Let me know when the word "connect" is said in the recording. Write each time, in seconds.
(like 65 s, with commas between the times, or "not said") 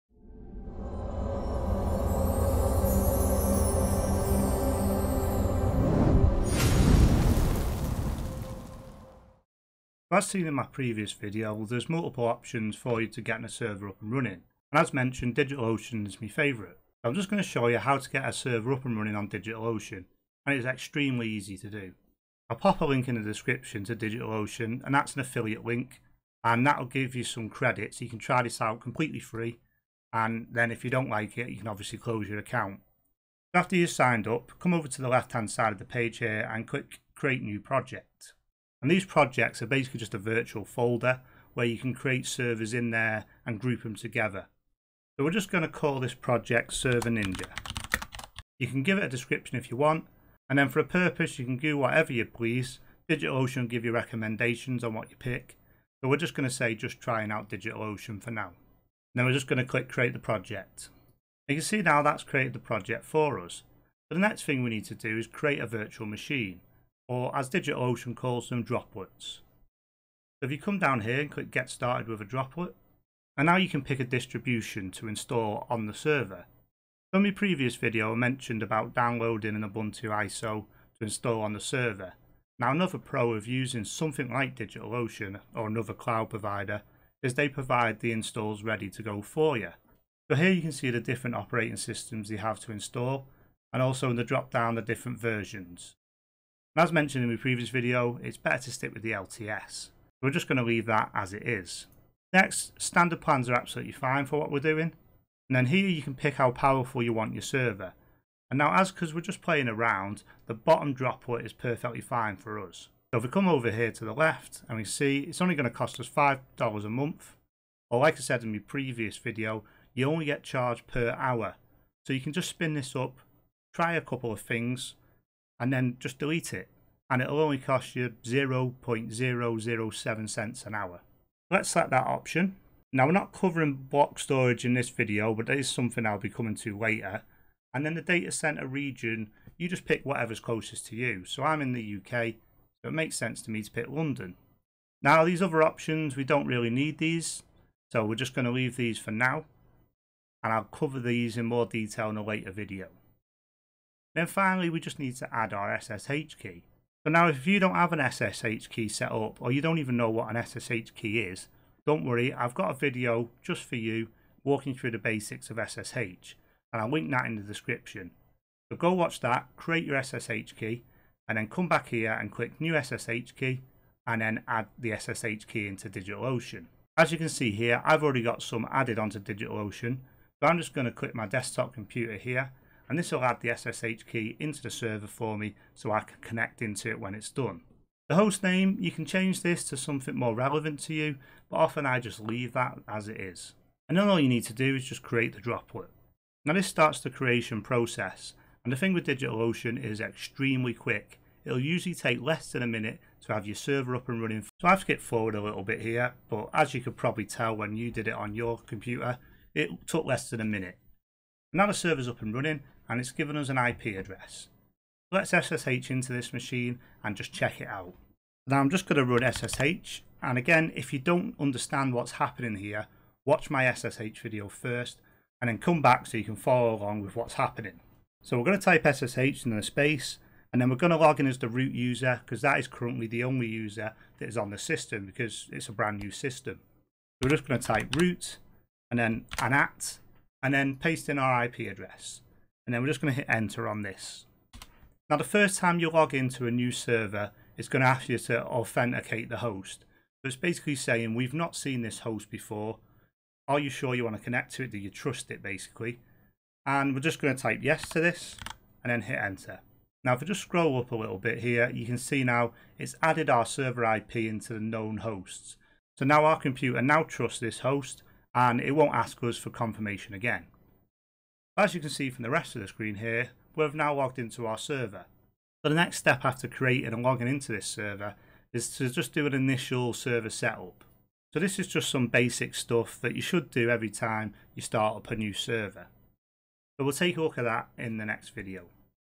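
186 s, 254 s.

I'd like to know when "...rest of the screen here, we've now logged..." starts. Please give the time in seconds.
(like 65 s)
272 s.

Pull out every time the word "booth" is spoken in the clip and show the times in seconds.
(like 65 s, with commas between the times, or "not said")
not said.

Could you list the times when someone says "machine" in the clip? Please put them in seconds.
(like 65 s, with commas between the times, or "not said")
66 s, 216 s.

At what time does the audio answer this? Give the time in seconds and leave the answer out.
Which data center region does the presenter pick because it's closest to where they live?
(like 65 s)
143 s.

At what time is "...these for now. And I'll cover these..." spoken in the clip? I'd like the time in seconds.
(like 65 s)
148 s.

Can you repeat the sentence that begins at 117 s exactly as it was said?
Or like I said in my previous video, you only get charged per hour.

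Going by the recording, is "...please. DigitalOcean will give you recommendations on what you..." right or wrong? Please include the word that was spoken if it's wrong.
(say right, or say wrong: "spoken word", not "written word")
right.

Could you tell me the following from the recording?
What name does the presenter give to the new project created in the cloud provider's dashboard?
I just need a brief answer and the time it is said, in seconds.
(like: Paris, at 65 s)
Server Ninja, at 46 s.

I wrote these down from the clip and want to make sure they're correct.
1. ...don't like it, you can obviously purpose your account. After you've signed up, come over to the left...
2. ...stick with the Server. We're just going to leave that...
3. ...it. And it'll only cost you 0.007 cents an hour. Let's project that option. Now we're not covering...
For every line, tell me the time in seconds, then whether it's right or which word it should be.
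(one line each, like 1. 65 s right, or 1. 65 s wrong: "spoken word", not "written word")
1. 30 s wrong: "close", not "purpose"
2. 98 s wrong: "LTS", not "Server"
3. 126 s wrong: "select", not "project".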